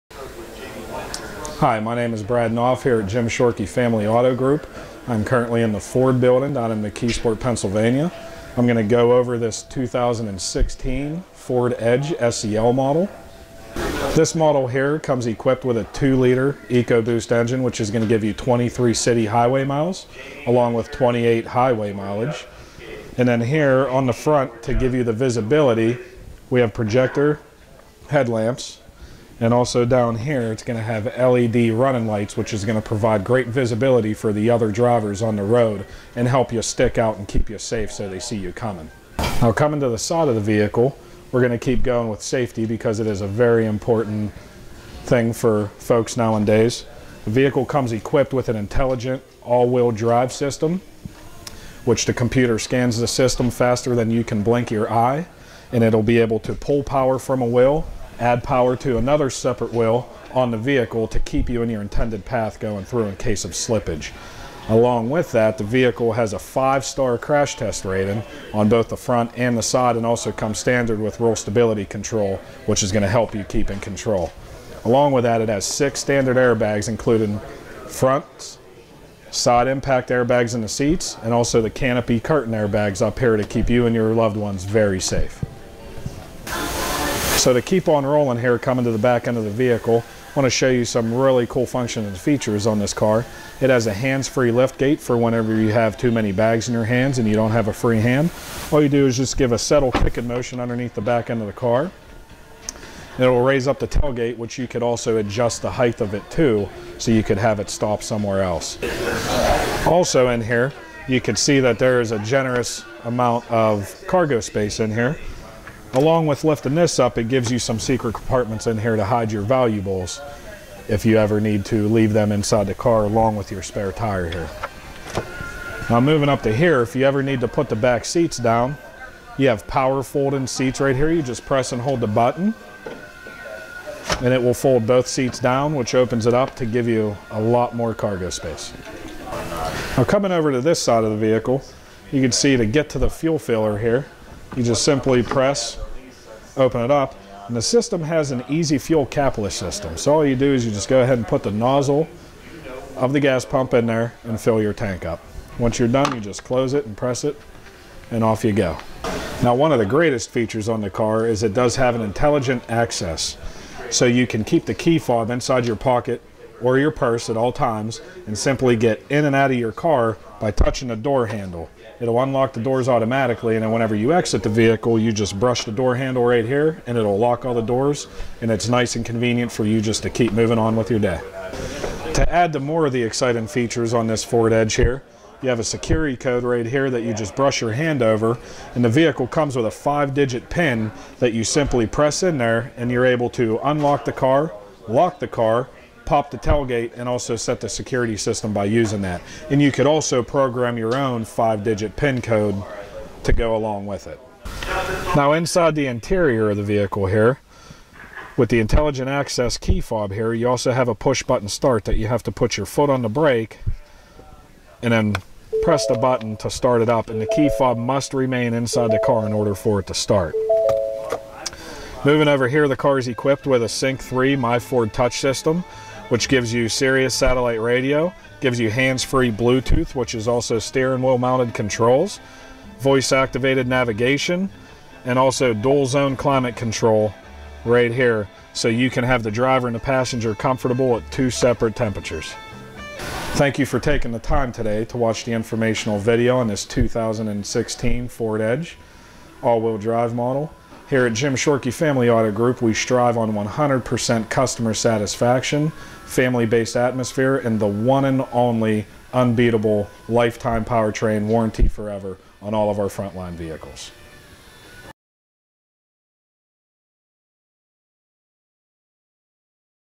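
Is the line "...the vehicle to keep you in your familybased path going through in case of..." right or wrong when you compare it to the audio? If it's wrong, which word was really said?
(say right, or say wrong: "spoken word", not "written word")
wrong: "intended", not "familybased".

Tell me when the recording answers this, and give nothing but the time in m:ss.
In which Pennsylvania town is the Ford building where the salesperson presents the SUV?
0:06.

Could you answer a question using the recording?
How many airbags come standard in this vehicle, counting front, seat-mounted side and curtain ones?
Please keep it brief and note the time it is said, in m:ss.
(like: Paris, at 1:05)
6, at 1:15.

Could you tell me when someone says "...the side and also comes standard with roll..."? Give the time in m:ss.
1:09.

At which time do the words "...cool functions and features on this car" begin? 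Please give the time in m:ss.
1:31.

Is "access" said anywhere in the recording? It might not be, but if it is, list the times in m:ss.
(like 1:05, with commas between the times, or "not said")
2:42, 3:29.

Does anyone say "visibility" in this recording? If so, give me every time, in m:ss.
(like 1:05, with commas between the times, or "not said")
0:25, 0:33.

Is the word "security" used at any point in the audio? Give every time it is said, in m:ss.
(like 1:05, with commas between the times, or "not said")
3:05, 3:17.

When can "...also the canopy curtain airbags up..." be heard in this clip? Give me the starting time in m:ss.
1:21.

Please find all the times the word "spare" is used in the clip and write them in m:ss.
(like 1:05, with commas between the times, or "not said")
2:03.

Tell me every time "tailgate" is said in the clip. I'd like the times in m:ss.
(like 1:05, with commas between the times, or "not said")
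1:43, 3:16.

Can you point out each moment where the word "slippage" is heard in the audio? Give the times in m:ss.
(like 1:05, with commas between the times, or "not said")
1:03.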